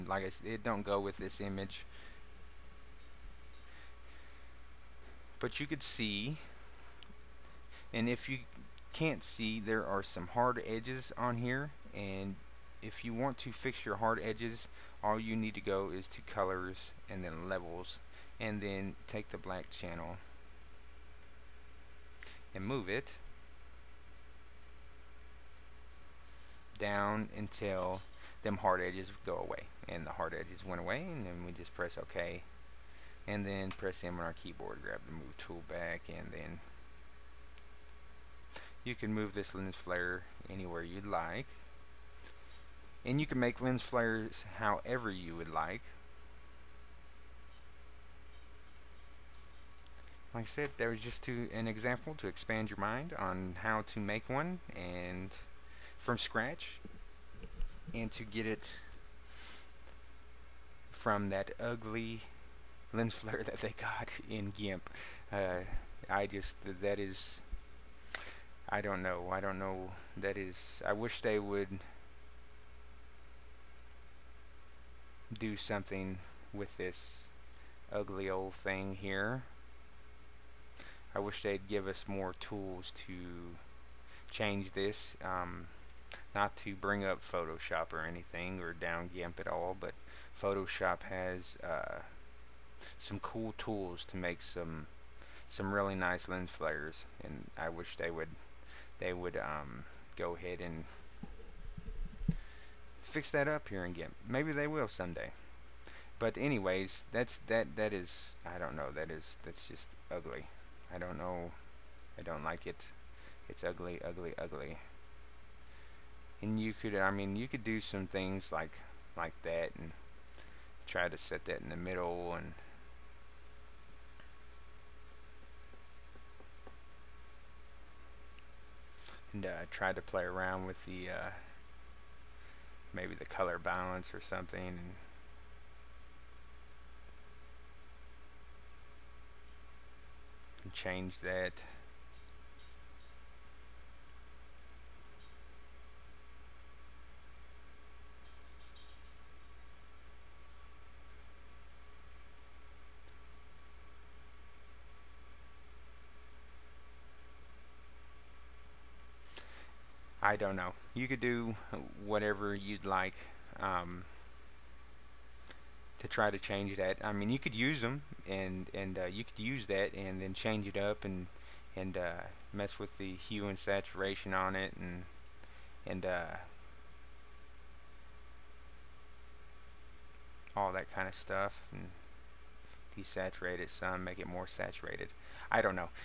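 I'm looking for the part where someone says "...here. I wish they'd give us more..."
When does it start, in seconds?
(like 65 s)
79 s.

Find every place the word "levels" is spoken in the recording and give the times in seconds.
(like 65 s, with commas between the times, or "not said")
17 s.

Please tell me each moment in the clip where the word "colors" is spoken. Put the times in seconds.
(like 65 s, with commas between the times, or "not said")
16 s, 133 s.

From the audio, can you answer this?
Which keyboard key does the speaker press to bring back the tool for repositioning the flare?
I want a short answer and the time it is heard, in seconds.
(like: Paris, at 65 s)
M, at 34 s.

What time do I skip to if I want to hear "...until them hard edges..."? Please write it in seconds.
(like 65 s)
27 s.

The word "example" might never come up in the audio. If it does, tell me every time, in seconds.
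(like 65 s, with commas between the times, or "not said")
51 s.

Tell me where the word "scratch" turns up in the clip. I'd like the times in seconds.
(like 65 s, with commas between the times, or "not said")
56 s.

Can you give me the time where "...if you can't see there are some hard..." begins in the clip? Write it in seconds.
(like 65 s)
8 s.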